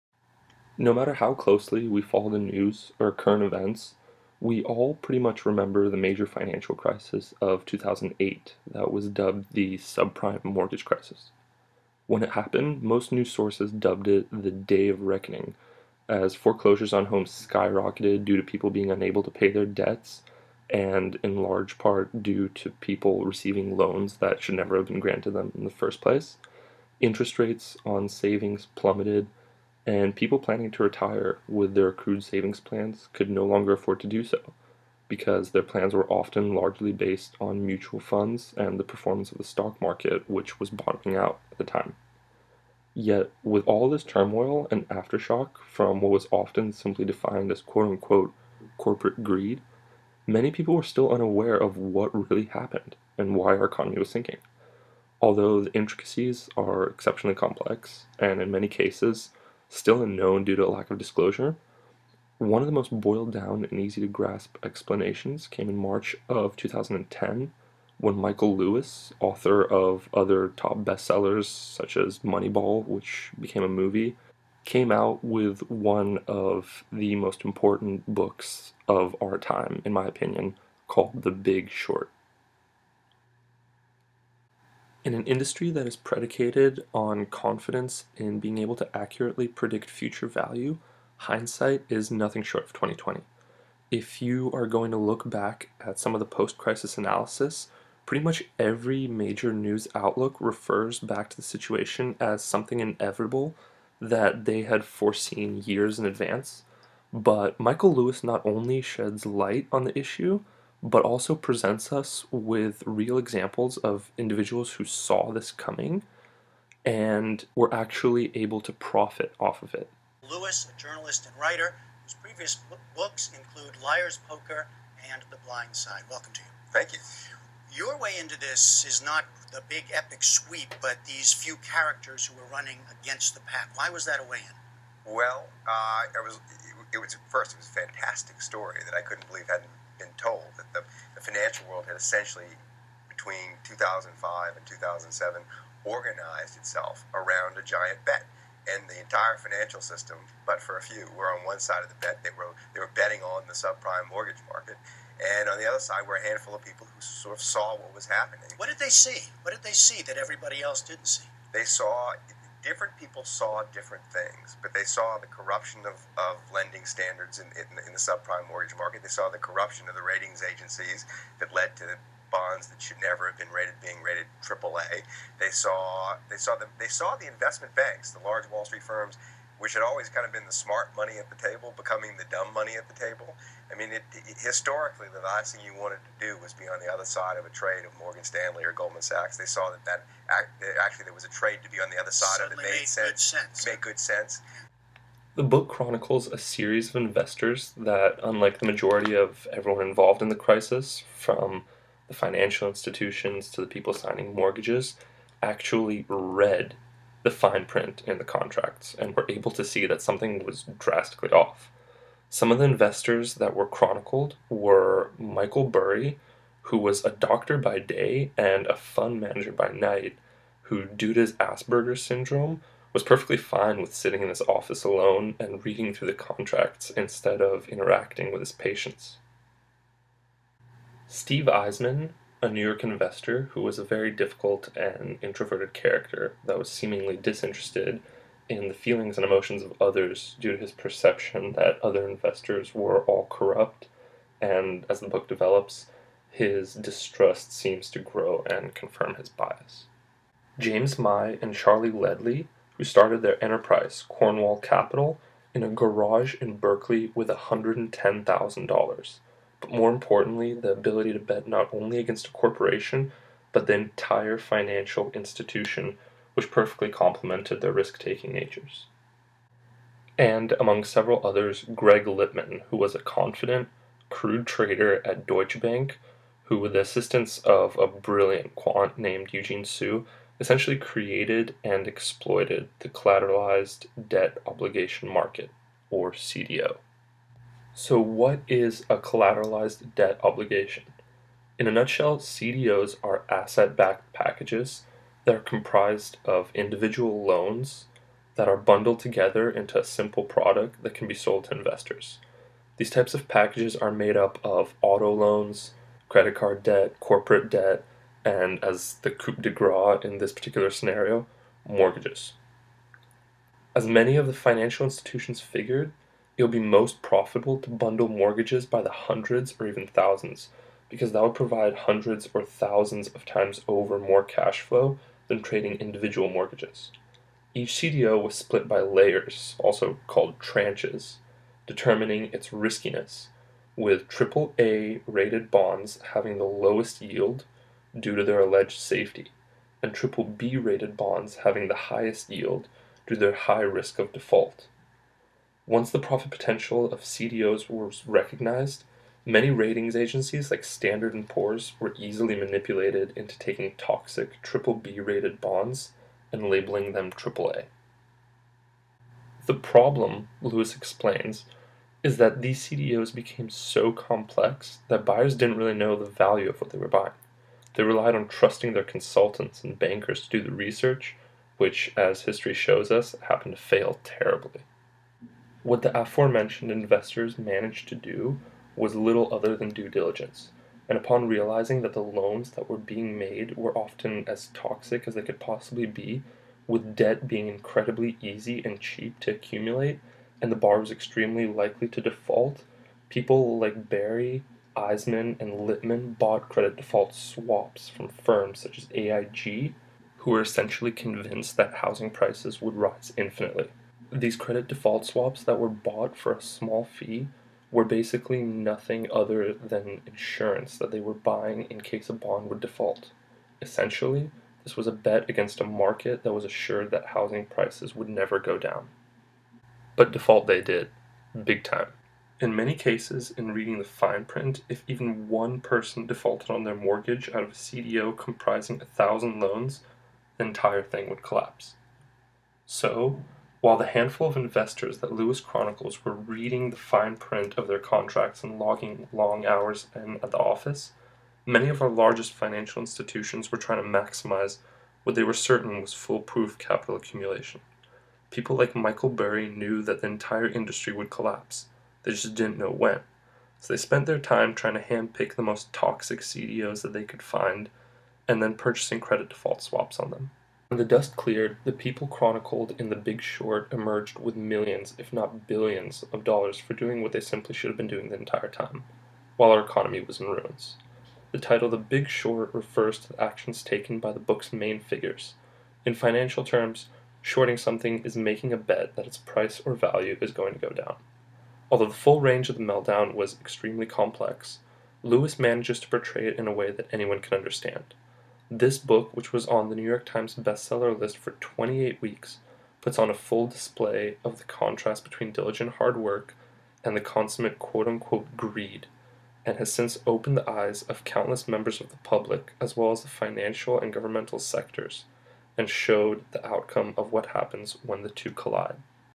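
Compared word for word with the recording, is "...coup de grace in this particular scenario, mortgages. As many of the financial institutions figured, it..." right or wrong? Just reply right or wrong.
right.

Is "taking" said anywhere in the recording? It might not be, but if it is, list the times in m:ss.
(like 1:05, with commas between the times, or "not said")
4:27, 5:53.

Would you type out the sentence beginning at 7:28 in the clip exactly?
People like Michael Burry knew that the entire industry would collapse.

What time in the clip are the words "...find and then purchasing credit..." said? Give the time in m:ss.
7:37.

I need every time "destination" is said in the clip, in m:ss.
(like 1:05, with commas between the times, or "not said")
not said.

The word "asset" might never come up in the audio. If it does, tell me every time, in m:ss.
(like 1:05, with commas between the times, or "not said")
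4:53.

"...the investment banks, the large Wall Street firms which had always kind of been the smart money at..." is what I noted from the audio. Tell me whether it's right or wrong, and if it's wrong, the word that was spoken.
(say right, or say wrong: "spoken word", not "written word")
right.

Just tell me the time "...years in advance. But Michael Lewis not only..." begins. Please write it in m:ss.
1:45.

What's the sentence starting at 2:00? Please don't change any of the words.
Lewis, a journalist and writer, whose previous books include Liar's Poker and The Blind Side.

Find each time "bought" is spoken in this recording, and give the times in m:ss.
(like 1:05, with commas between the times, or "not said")
6:36, 6:45.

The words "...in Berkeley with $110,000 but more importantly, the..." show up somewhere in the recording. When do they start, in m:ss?
4:16.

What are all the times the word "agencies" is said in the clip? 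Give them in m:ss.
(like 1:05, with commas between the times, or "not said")
2:50, 5:49.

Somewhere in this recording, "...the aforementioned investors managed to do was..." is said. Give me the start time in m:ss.
6:15.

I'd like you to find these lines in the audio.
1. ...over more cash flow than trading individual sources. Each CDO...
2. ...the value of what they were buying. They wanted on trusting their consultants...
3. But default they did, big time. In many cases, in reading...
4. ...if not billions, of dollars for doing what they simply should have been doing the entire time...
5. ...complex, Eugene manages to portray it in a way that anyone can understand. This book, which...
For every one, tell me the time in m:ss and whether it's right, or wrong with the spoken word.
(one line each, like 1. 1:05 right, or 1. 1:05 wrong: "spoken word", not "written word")
1. 5:23 wrong: "mortgages", not "sources"
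2. 6:05 wrong: "relied", not "wanted"
3. 6:59 right
4. 7:44 right
5. 8:03 wrong: "Lewis", not "Eugene".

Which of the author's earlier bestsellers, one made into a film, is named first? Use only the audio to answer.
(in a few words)
Moneyball.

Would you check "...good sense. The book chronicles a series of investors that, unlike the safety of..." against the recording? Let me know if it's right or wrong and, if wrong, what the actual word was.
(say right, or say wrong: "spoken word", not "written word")
wrong: "majority", not "safety".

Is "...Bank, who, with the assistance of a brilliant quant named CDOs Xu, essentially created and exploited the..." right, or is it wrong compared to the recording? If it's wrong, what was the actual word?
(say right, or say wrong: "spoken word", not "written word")
wrong: "Eugene", not "CDOs".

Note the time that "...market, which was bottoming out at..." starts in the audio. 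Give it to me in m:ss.
0:39.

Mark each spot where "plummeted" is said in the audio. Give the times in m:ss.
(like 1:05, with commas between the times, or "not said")
0:28.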